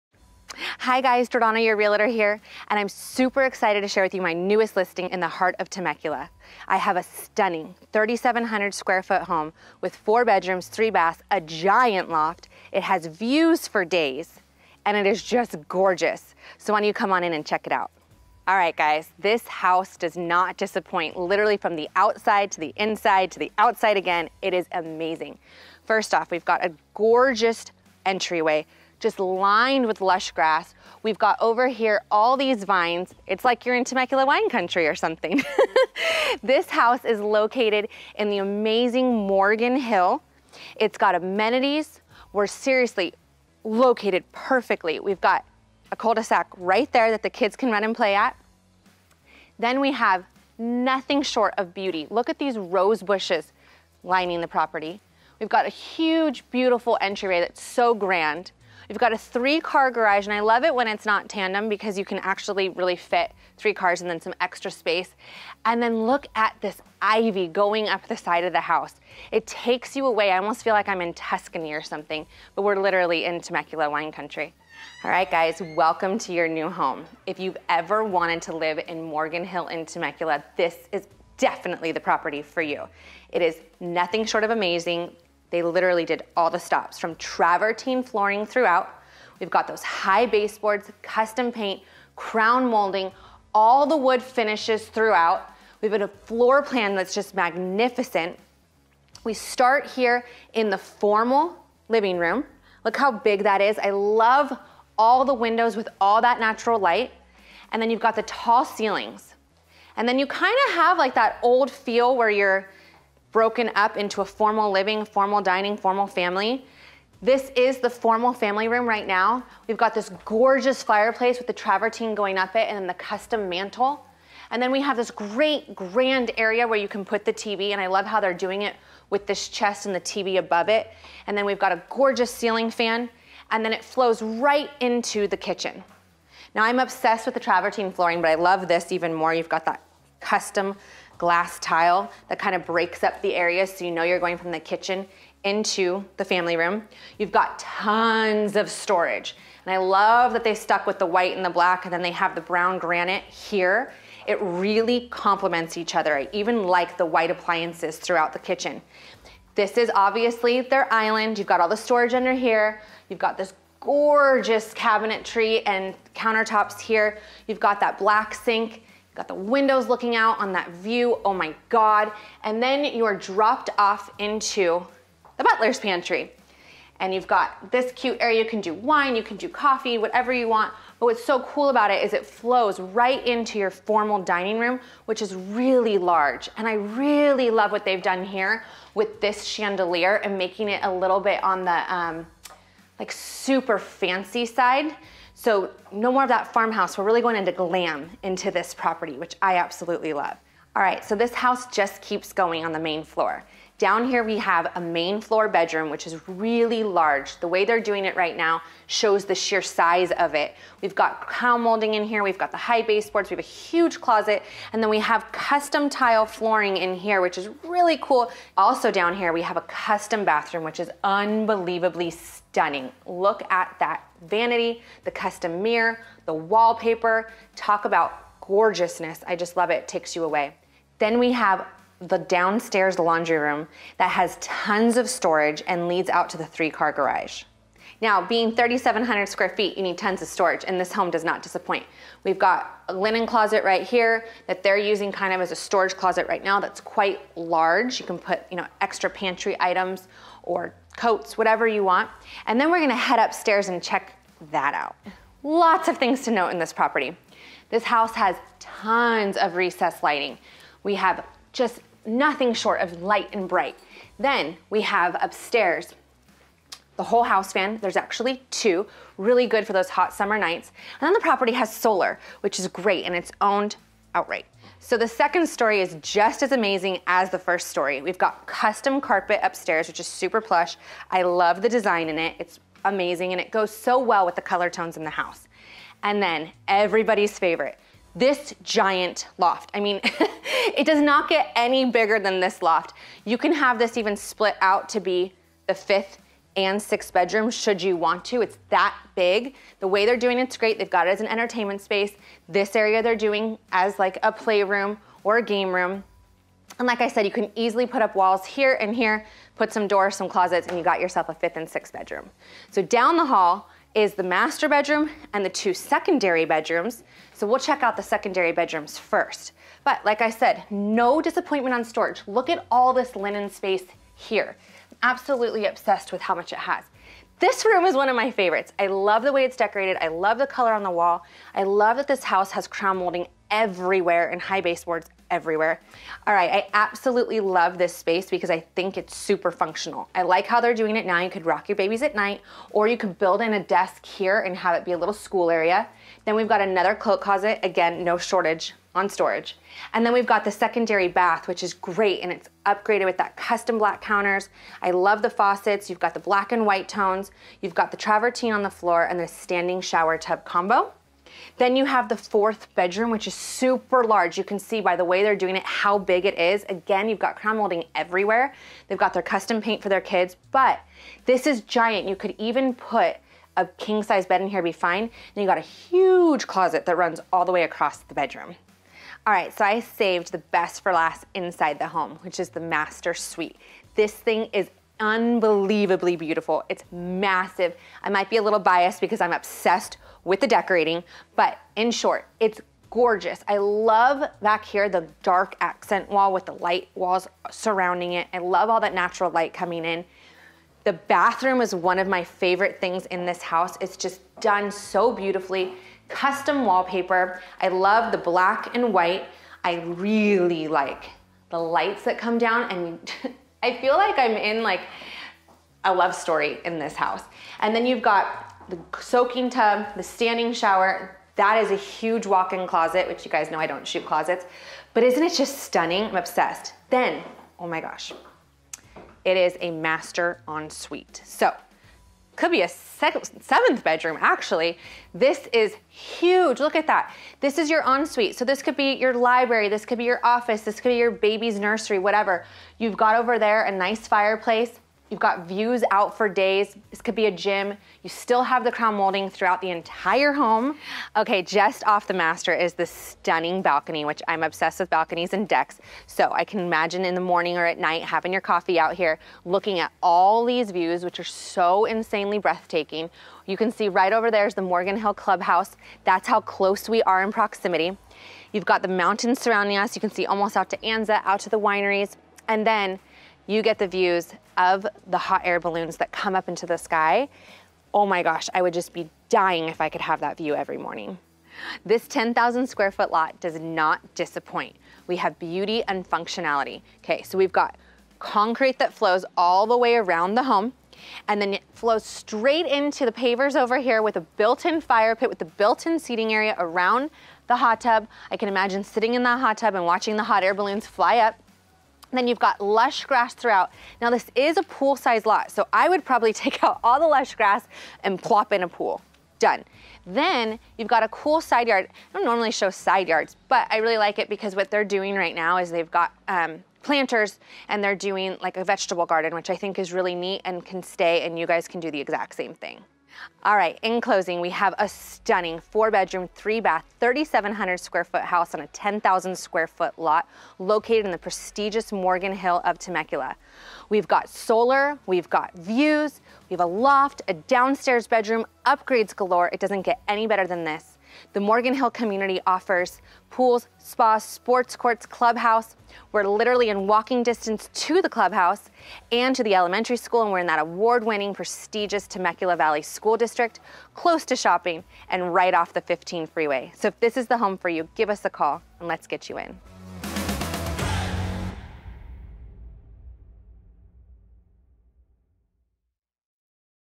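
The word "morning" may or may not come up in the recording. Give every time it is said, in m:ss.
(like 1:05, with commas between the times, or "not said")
7:37, 8:00.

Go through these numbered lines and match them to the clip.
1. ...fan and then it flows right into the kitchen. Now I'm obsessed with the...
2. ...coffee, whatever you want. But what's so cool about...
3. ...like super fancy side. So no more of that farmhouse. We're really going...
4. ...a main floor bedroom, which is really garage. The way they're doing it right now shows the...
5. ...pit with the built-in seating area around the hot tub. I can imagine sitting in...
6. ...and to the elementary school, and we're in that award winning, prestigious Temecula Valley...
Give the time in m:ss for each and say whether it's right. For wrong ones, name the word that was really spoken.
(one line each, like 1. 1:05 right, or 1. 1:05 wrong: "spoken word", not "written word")
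1. 2:12 right
2. 2:59 right
3. 3:13 right
4. 3:24 wrong: "large", not "garage"
5. 8:15 right
6. 9:09 right.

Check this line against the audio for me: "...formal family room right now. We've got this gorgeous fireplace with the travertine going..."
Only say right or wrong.
right.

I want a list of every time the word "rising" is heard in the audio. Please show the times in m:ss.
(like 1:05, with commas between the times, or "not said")
not said.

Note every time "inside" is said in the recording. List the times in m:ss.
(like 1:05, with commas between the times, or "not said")
0:22, 6:21.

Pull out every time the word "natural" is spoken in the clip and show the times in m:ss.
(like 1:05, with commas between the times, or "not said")
1:46, 6:38.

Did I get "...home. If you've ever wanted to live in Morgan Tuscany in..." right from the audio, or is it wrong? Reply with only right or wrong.
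wrong.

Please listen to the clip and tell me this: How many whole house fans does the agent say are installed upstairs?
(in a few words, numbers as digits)
2.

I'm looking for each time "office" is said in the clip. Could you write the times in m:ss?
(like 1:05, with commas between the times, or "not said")
7:20.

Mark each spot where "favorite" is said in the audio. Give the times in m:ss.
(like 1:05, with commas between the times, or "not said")
4:47, 5:28, 6:42.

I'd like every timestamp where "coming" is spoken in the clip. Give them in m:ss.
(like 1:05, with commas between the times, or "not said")
6:39.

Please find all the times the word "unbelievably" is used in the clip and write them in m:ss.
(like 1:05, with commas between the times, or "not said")
3:41, 6:25.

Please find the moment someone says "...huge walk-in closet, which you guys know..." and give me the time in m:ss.
7:01.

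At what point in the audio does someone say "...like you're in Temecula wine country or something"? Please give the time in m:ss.
0:33.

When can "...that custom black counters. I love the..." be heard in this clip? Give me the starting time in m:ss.
5:53.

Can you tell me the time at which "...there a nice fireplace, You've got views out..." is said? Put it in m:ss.
7:23.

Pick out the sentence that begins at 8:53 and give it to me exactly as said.
We've got solar, we've got views, we have a loft, a downstairs bedroom, upgrades galore.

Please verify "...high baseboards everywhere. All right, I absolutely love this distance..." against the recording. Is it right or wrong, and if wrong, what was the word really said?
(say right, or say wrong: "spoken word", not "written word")
wrong: "space", not "distance".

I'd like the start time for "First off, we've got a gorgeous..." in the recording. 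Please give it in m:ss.
0:25.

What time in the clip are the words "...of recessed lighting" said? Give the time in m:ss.
4:19.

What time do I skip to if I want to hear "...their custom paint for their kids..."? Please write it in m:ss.
6:09.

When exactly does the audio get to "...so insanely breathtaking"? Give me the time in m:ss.
7:41.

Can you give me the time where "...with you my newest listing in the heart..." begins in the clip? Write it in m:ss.
0:04.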